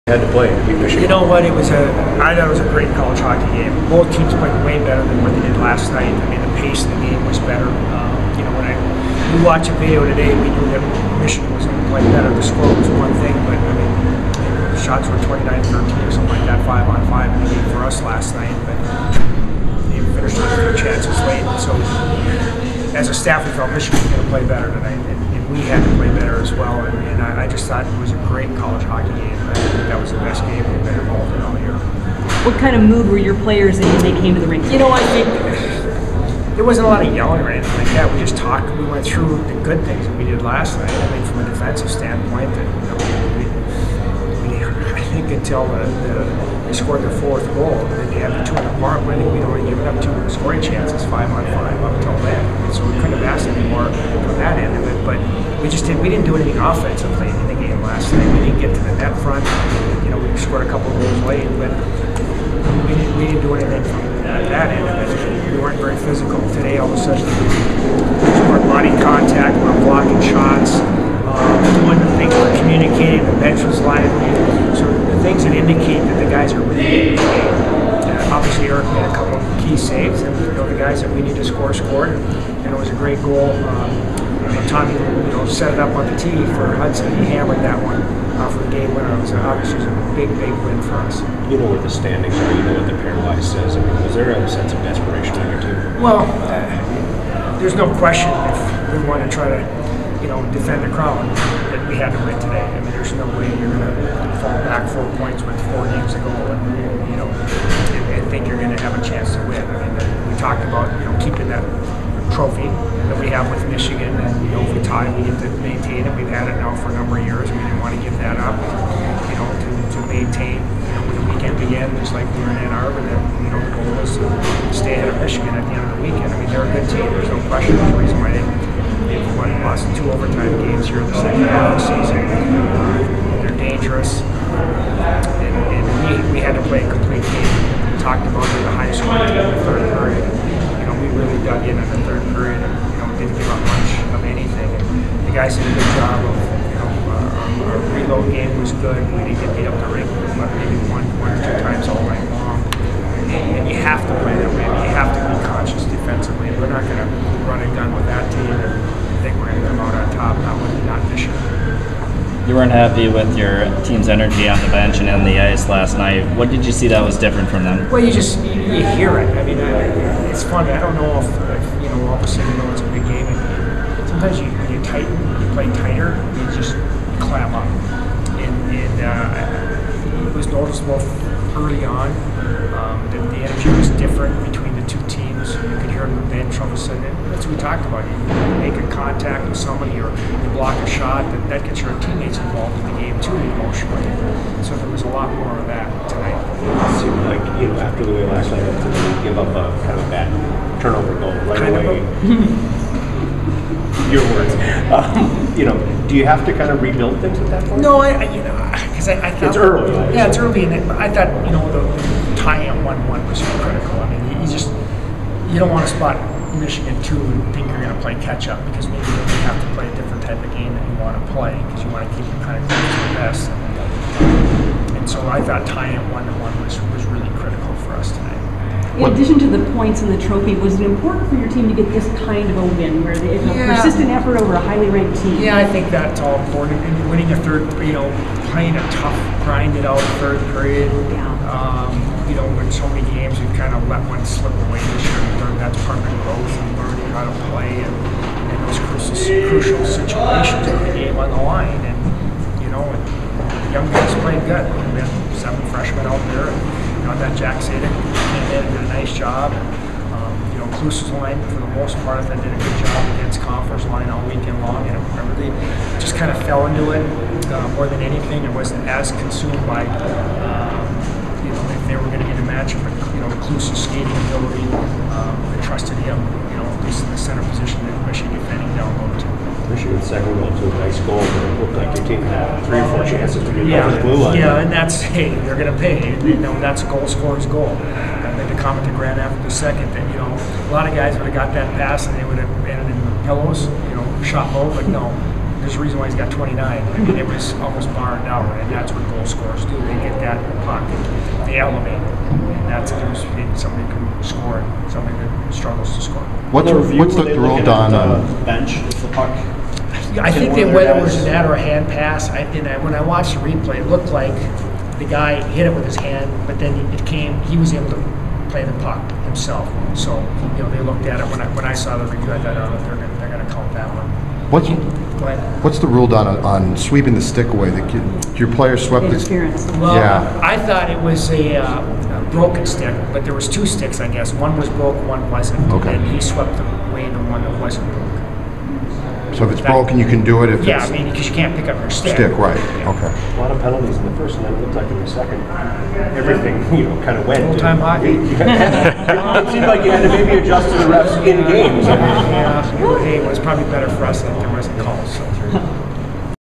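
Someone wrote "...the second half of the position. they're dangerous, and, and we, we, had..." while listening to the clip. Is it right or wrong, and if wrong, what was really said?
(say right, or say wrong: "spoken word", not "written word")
wrong: "season", not "position".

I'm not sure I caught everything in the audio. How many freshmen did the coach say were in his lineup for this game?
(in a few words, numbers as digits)
7.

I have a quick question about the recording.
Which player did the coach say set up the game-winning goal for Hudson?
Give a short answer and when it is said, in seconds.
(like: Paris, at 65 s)
Tommy, at 84 s.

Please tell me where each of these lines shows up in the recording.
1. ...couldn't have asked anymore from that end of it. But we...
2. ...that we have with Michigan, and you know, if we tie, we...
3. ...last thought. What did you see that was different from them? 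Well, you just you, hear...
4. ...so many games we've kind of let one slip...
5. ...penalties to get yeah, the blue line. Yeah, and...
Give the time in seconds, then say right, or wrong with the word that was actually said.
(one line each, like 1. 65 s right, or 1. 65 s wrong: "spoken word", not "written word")
1. 52 s right
2. 113 s right
3. 165 s wrong: "night", not "thought"
4. 242 s right
5. 283 s wrong: "chances", not "penalties".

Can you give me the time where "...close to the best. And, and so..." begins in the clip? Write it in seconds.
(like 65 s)
222 s.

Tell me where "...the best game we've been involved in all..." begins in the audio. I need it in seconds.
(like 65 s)
30 s.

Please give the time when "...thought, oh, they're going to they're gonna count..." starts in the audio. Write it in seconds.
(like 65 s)
322 s.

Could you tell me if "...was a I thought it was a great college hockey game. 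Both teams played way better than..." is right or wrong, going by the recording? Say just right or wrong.
right.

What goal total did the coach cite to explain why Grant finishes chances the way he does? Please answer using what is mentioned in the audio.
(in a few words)
29.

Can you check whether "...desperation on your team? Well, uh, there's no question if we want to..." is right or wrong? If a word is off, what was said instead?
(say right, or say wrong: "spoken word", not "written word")
right.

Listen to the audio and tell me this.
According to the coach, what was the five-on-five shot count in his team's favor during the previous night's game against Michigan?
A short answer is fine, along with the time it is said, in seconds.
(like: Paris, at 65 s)
29-13, at 15 s.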